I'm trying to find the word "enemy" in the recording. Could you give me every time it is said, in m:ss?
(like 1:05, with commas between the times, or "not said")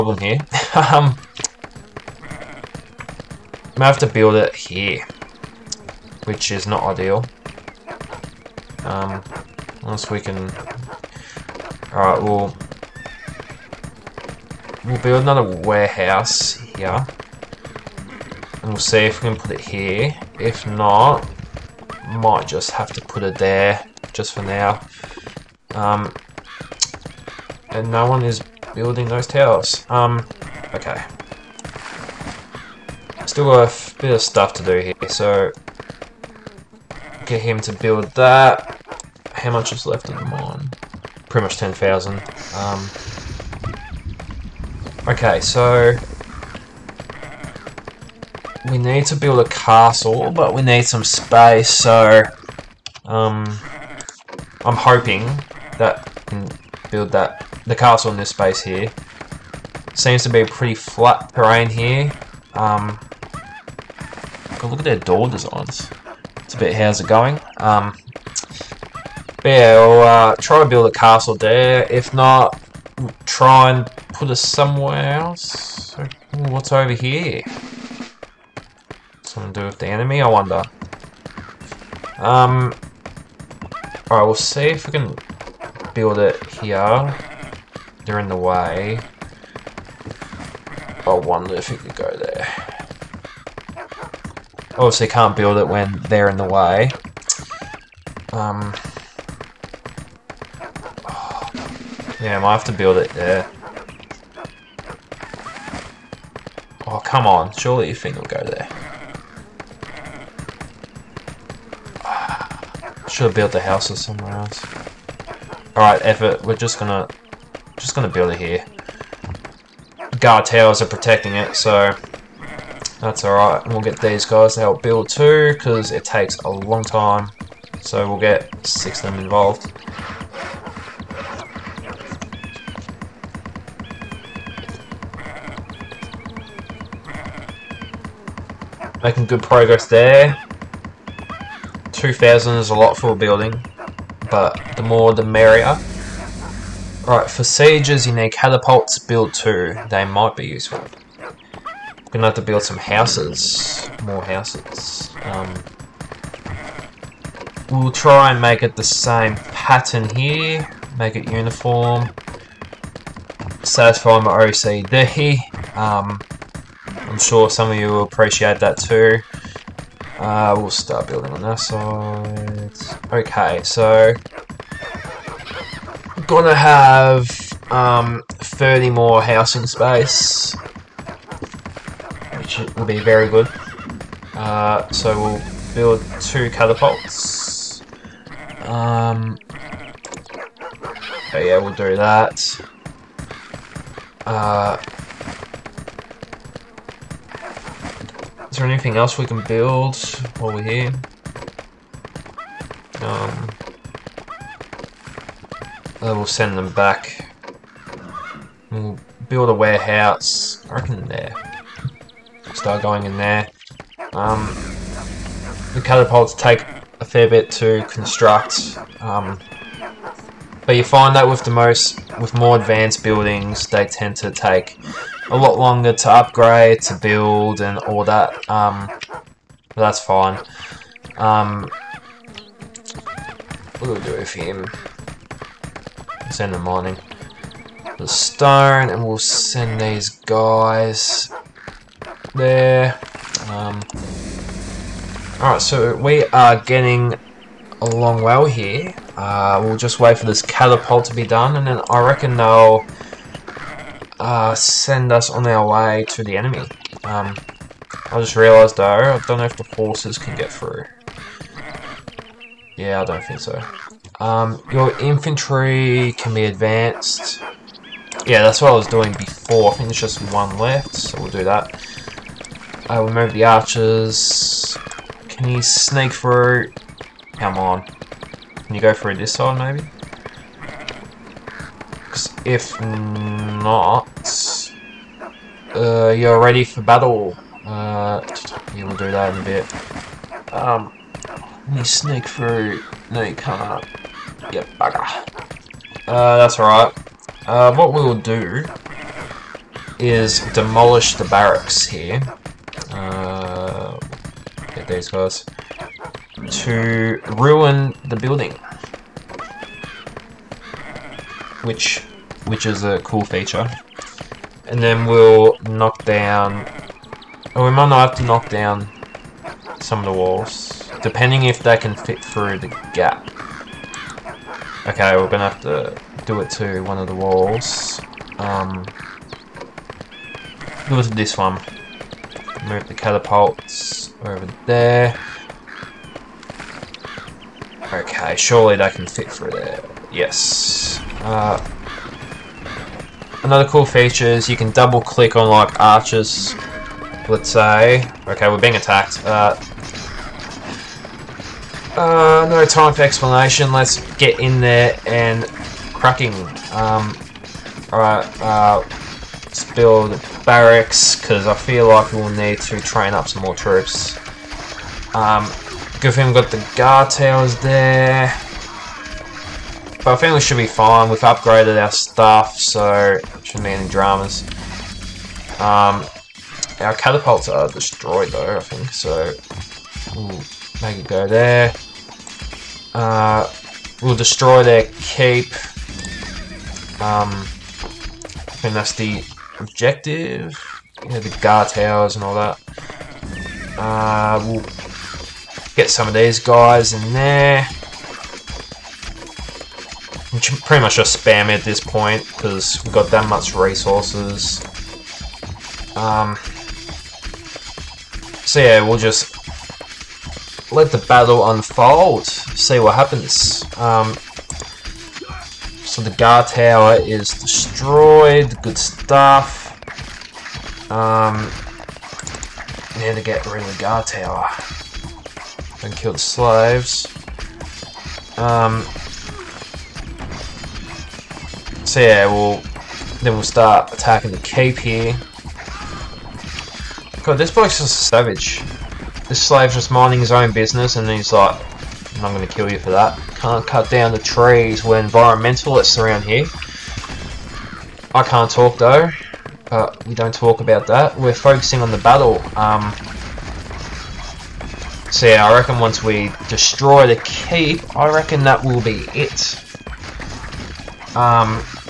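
1:19, 4:16.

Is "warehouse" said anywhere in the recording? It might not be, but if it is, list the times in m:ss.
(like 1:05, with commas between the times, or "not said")
0:15, 3:29.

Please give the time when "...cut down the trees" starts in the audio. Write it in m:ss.
7:23.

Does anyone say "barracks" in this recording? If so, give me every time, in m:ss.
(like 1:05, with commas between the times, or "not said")
5:01, 6:00.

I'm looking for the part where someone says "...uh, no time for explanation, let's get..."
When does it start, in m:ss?
5:51.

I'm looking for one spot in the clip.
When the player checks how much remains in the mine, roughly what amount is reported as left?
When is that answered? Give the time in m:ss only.
0:41.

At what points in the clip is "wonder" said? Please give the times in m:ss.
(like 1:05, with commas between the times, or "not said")
1:20, 1:31.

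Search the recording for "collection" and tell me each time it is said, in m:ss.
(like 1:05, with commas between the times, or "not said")
not said.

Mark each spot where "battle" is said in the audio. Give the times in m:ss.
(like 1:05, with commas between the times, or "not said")
4:46, 6:51, 7:31.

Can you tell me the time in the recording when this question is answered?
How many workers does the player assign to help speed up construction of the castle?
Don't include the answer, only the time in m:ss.
2:08.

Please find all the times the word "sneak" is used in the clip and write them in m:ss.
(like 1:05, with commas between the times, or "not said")
4:35, 4:51.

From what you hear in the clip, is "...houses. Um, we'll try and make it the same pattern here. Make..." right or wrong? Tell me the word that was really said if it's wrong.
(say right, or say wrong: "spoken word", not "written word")
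right.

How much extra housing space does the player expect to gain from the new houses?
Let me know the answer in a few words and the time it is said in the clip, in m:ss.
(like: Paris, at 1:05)
30, at 2:58.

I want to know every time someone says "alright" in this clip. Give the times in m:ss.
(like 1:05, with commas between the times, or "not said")
0:11, 1:24, 1:55, 2:03, 4:05, 4:56, 5:57.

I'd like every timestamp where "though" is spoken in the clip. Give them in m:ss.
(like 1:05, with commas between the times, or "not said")
4:18, 6:18, 7:28.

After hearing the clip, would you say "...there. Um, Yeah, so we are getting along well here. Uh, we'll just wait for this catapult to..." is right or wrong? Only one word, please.
wrong.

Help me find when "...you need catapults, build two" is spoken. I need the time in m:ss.
2:28.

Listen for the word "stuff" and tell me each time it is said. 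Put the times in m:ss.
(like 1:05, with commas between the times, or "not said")
0:34, 6:11, 6:58.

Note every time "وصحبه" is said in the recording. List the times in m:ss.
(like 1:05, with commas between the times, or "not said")
not said.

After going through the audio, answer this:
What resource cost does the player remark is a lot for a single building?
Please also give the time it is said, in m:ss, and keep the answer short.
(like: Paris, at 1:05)
2,000, at 2:21.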